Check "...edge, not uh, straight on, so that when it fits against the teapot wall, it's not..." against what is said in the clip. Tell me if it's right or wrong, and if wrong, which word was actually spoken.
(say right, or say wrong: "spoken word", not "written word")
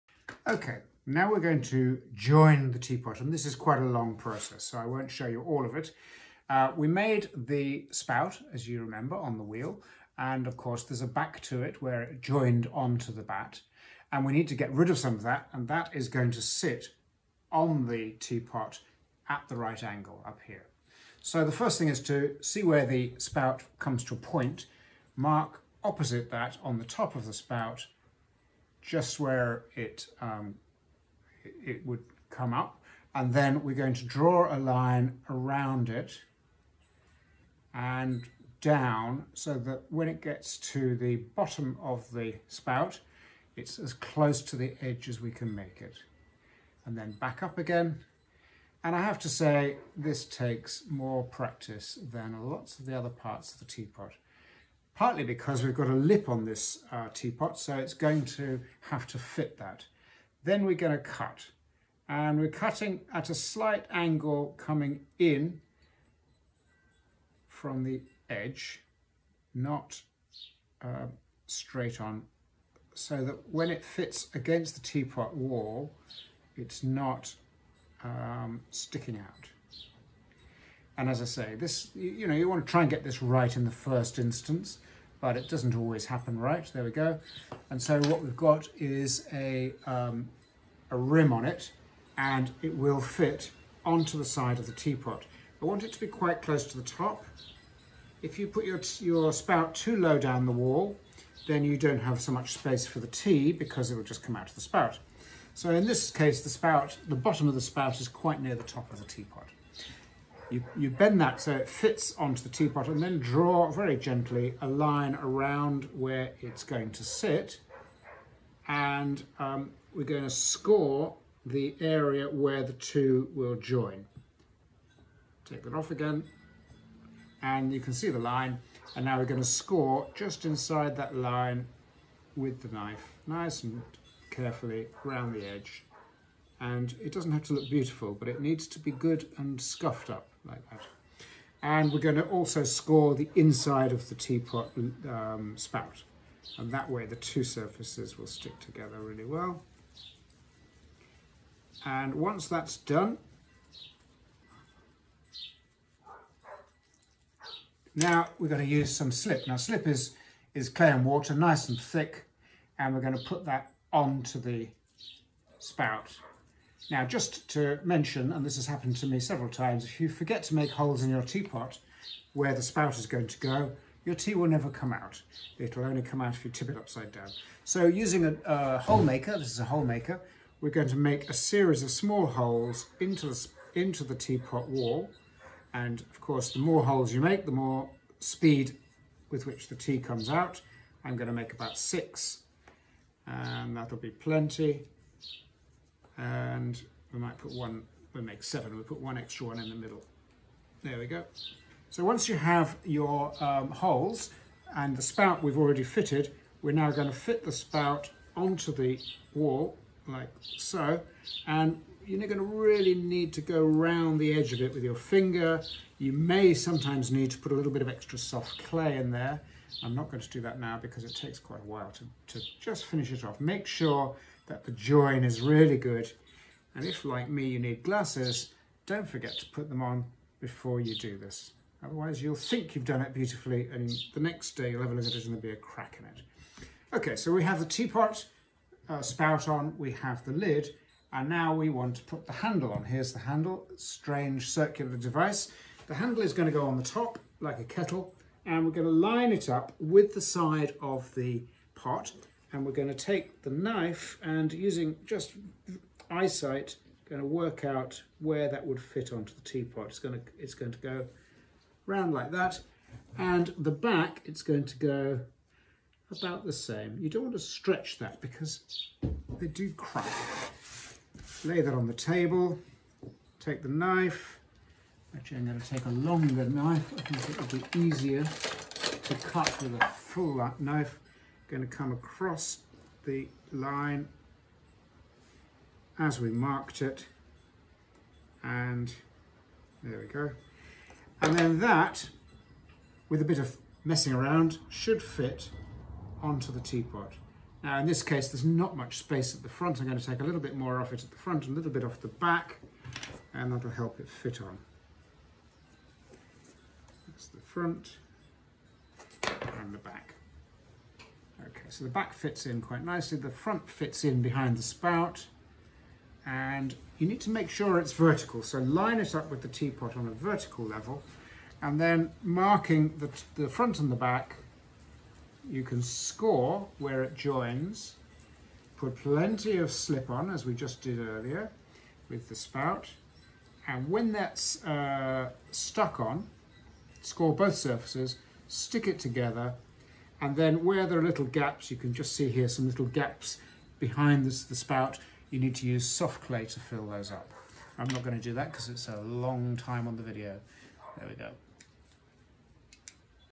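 right.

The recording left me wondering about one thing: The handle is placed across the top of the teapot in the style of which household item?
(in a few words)
a kettle.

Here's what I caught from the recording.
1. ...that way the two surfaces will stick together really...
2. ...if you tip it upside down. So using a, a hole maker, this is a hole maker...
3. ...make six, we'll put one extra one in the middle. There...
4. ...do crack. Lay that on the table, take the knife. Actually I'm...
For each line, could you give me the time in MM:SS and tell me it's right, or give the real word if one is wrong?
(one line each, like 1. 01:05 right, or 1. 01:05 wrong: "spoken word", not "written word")
1. 02:26 right
2. 02:56 right
3. 03:18 wrong: "seven", not "six"
4. 04:29 right.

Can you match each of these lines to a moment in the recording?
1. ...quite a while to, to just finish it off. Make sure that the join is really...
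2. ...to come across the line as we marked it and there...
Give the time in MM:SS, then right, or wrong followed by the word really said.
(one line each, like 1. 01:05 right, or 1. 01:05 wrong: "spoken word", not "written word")
1. 03:41 right
2. 04:41 right.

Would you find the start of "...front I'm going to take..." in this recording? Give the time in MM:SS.
04:59.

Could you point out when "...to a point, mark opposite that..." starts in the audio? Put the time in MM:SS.
00:24.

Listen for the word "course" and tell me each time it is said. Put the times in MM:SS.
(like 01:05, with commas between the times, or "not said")
00:10, 03:06.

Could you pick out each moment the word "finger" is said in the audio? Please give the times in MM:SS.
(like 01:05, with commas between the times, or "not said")
03:34.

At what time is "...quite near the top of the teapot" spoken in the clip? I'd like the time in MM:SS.
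01:48.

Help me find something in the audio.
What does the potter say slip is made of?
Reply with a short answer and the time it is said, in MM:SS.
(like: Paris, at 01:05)
clay and water, at 02:40.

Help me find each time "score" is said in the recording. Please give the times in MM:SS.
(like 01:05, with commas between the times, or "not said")
02:00, 02:09, 02:22, 05:25, 05:37.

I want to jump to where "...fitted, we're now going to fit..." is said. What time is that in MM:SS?
03:25.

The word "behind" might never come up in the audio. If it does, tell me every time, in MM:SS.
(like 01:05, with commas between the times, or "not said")
05:14, 05:43.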